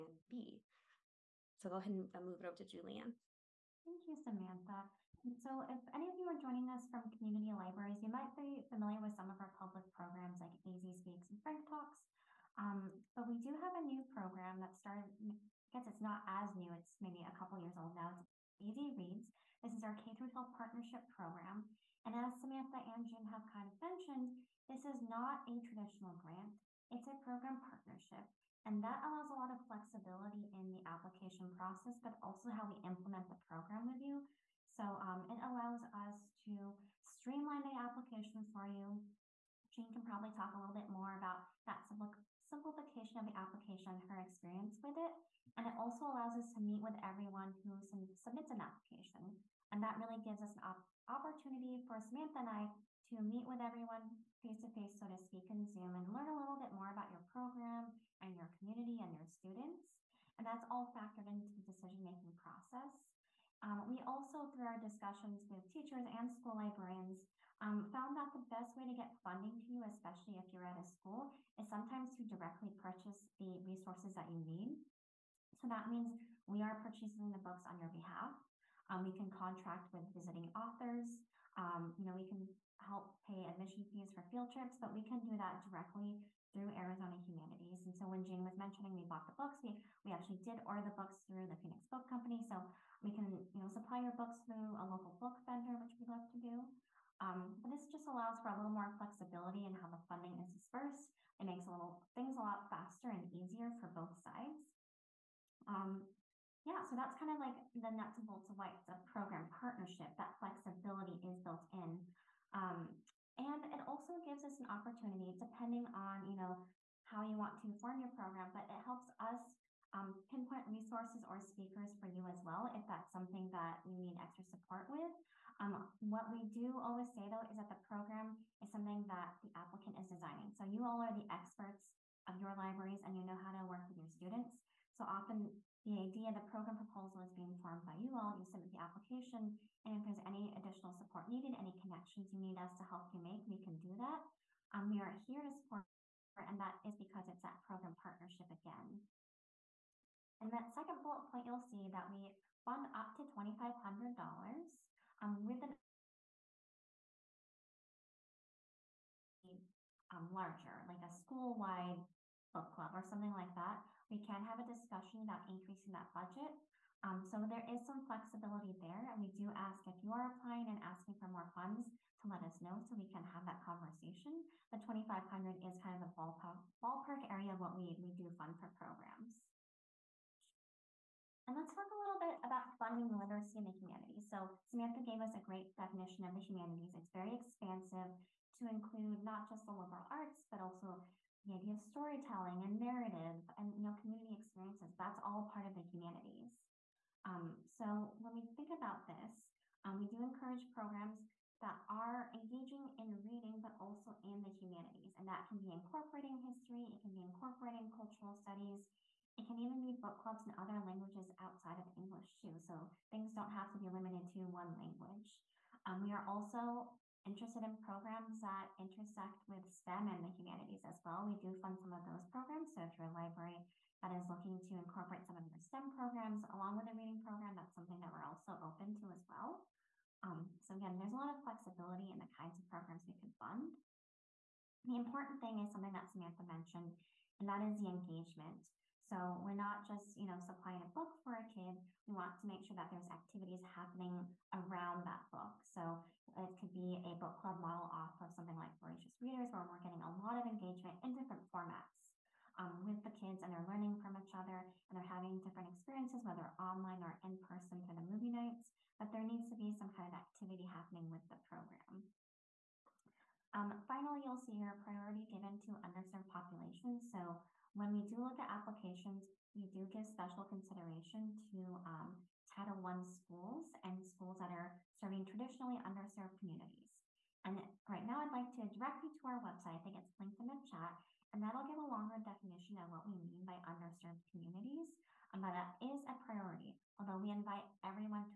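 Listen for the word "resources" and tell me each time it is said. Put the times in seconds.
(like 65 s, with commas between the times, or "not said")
73 s, 120 s.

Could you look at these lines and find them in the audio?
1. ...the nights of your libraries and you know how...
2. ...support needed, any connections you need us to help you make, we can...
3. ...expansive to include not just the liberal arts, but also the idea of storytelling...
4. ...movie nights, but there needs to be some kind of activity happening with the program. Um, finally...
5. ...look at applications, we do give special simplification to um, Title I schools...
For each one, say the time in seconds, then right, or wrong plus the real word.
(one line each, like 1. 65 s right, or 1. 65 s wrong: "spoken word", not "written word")
1. 131 s wrong: "experts", not "nights"
2. 140 s right
3. 187 s right
4. 258 s right
5. 268 s wrong: "consideration", not "simplification".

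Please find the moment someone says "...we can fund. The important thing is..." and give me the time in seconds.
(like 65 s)
233 s.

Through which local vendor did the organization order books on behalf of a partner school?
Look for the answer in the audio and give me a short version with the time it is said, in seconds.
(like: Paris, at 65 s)
Phoenix Book Company, at 91 s.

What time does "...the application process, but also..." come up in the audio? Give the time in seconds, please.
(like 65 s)
30 s.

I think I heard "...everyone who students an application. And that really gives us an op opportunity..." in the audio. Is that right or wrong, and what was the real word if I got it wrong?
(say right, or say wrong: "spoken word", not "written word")
wrong: "submits", not "students".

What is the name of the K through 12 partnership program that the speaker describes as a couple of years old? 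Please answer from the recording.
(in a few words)
AZ Reads.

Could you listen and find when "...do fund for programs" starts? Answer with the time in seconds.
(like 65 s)
178 s.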